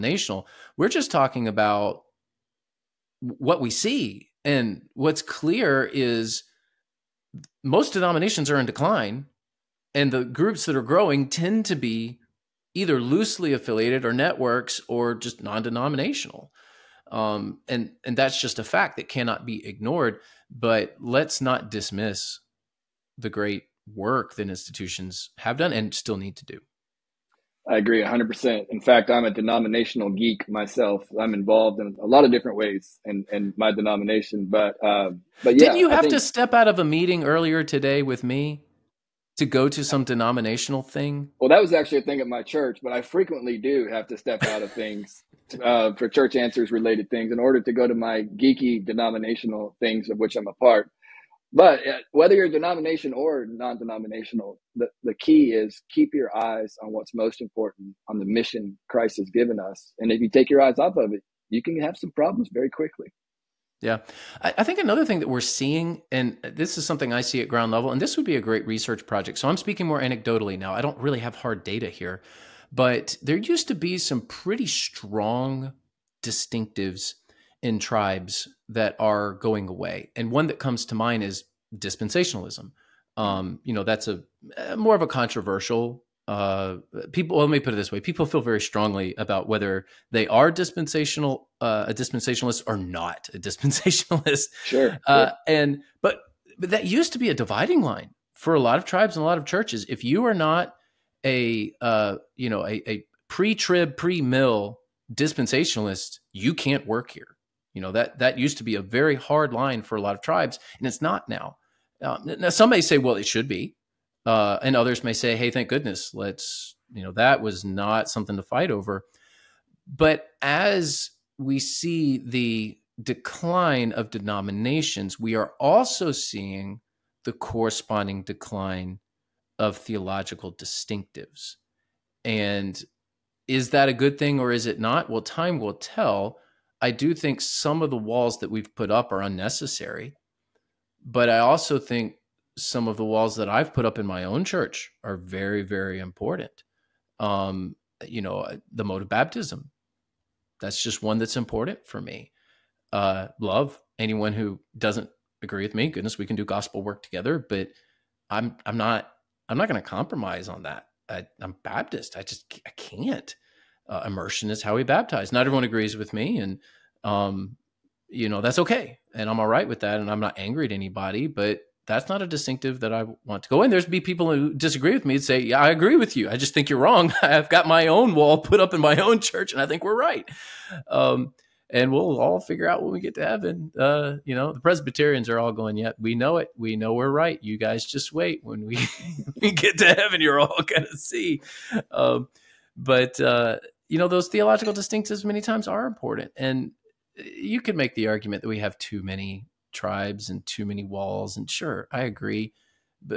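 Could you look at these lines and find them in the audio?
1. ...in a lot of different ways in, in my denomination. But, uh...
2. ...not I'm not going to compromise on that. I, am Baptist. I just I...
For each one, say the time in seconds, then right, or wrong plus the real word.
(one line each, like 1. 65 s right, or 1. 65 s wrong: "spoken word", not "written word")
1. 31 s right
2. 158 s right.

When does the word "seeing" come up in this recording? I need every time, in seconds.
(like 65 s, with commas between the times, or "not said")
65 s, 126 s.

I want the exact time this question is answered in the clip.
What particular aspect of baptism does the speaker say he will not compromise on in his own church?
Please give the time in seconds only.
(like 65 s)
148 s.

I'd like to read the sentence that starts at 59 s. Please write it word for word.
And if you take your eyes off of it, you can have some problems very quickly.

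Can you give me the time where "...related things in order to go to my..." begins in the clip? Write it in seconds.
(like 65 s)
46 s.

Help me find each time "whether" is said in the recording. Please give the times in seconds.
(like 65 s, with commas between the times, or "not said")
52 s, 89 s.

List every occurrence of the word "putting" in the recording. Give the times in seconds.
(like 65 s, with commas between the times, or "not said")
not said.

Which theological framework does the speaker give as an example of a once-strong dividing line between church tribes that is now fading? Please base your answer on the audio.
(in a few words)
Dispensationalism.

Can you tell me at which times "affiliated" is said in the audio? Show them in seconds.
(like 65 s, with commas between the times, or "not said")
13 s.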